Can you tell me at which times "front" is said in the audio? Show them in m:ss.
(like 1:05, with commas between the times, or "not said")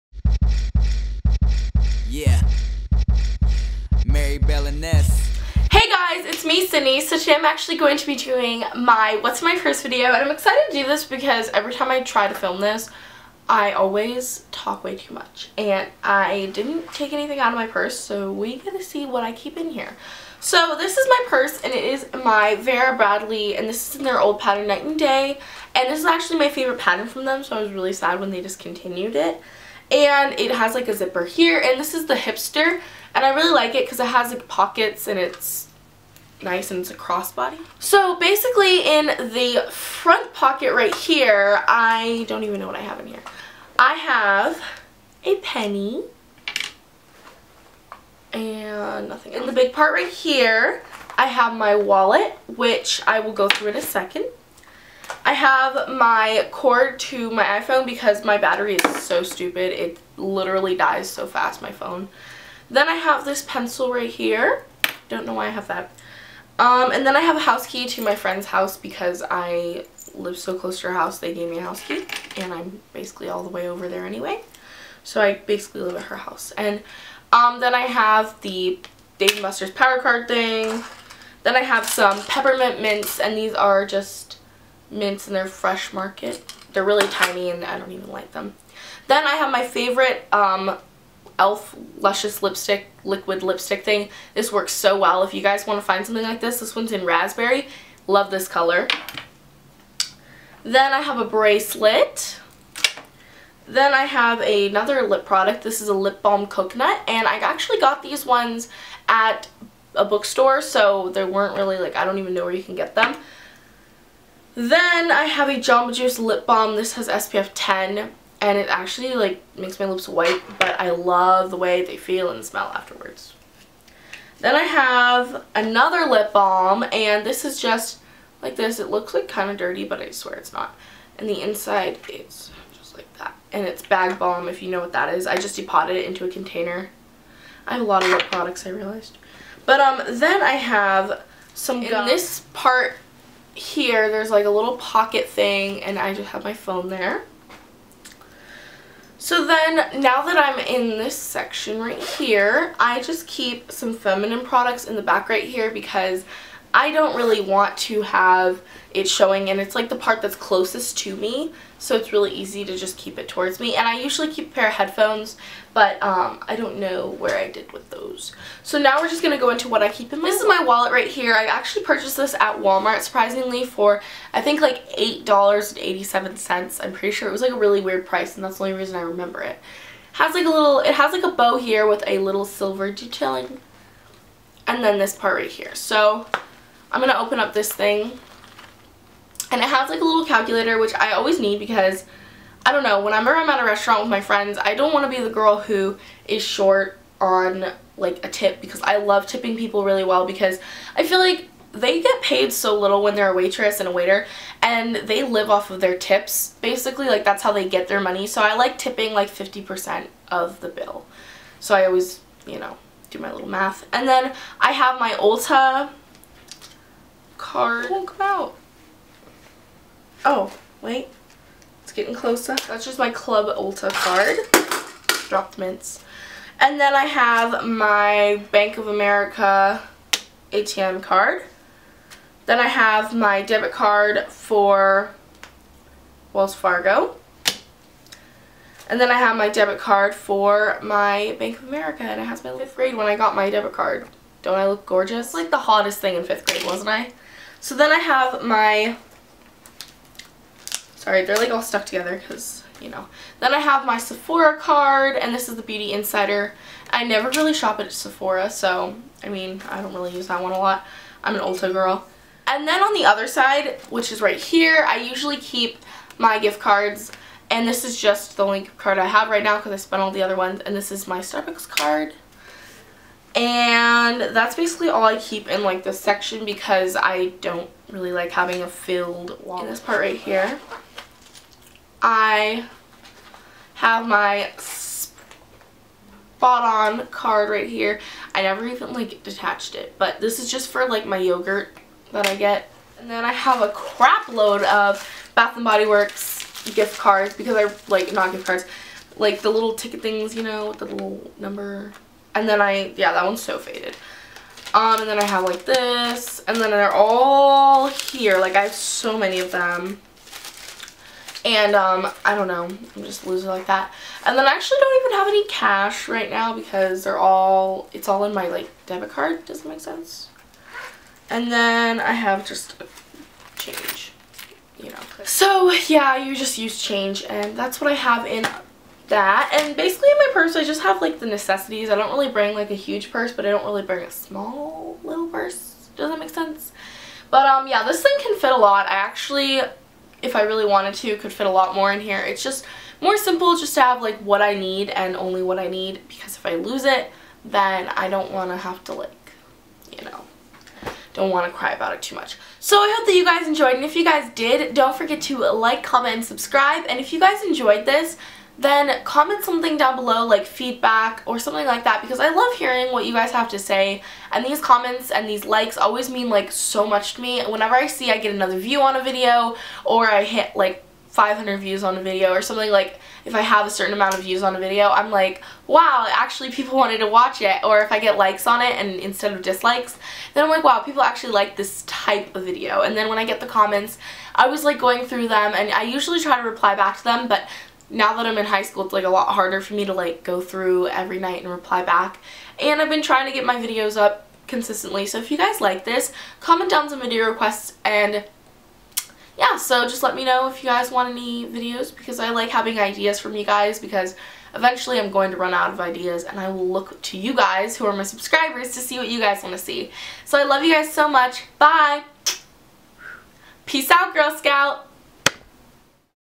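0:39.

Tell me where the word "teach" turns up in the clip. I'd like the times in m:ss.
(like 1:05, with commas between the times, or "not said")
not said.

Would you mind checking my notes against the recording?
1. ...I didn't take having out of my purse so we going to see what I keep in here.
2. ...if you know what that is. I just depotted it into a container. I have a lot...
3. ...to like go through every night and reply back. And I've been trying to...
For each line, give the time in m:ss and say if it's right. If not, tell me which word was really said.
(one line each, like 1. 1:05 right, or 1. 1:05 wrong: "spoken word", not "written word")
1. 0:16 wrong: "anything", not "having"
2. 2:14 right
3. 6:29 right.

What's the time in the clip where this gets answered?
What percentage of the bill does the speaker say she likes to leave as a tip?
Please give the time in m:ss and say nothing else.
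3:29.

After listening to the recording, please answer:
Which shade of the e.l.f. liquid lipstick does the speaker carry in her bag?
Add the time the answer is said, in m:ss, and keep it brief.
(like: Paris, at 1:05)
Raspberry, at 1:37.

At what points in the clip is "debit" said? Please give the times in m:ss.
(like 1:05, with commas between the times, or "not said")
3:53, 3:59, 4:03, 5:18.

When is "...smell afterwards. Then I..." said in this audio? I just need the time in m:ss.
2:02.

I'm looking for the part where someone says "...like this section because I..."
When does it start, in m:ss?
4:35.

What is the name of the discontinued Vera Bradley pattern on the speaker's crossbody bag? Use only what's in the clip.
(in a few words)
Night and Day.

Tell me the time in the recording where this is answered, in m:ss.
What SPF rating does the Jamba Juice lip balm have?
1:57.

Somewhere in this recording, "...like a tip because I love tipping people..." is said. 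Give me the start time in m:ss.
3:17.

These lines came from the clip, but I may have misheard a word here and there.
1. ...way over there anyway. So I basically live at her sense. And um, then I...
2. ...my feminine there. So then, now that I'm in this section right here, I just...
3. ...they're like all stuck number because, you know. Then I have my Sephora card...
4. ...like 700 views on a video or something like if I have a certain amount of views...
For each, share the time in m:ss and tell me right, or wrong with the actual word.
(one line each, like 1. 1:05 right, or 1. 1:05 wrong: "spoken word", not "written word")
1. 1:13 wrong: "house", not "sense"
2. 2:26 wrong: "phone", not "feminine"
3. 4:11 wrong: "together", not "number"
4. 6:10 wrong: "500", not "700".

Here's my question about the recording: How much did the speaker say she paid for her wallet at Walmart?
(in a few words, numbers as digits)
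$8.87.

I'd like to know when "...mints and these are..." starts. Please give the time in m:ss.
1:22.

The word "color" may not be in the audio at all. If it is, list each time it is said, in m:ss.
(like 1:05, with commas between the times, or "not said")
1:38.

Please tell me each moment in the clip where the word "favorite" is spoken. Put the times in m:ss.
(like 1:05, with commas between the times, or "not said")
0:26, 1:29.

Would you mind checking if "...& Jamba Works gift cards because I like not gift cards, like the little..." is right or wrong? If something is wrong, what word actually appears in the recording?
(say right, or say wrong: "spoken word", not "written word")
wrong: "Body", not "Jamba".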